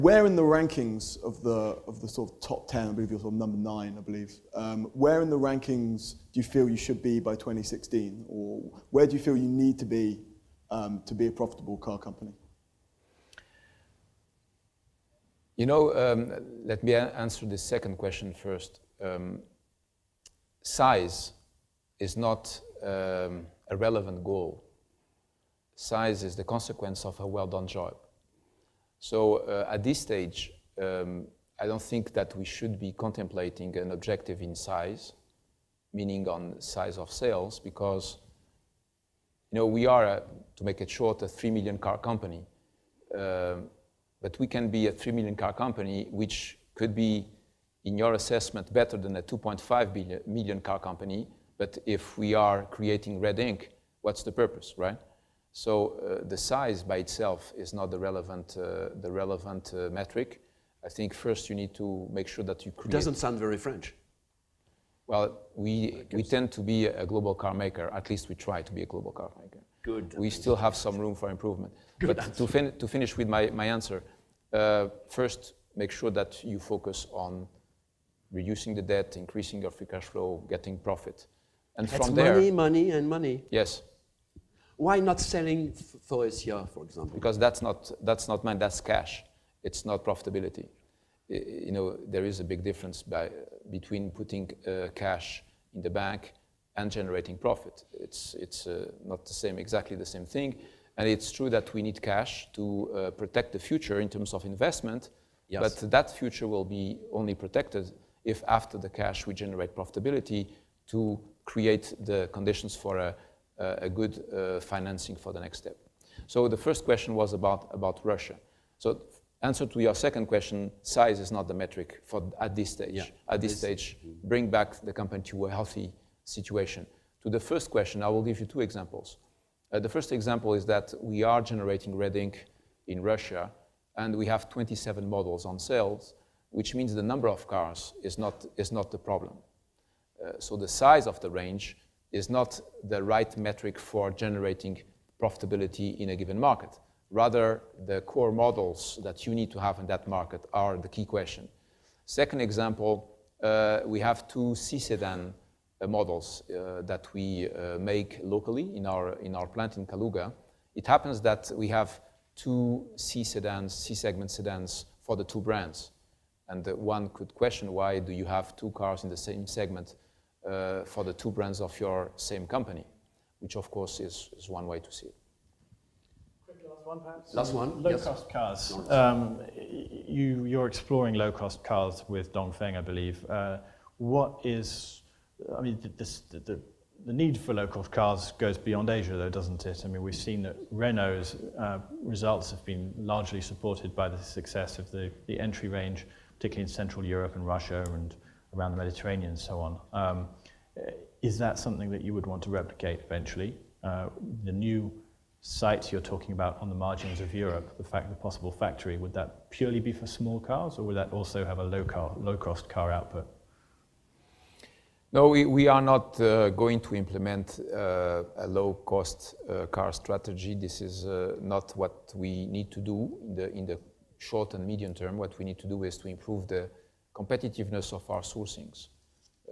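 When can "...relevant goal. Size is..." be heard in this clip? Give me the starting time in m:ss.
0:23.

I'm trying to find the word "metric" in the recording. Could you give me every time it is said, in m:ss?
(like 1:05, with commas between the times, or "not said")
0:59, 2:01, 2:23.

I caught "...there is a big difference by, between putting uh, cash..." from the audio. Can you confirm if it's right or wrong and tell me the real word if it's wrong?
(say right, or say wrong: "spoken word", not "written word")
right.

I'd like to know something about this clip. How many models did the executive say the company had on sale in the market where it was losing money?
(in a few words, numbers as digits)
27.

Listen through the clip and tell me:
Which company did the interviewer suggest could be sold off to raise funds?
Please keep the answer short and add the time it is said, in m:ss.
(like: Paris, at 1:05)
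Faurecia, at 1:26.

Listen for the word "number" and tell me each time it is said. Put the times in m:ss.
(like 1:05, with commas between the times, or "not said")
0:03, 2:17.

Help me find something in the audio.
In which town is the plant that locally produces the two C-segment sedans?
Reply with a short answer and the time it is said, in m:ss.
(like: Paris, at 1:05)
Kaluga, at 2:39.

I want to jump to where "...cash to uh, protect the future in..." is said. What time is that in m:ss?
1:42.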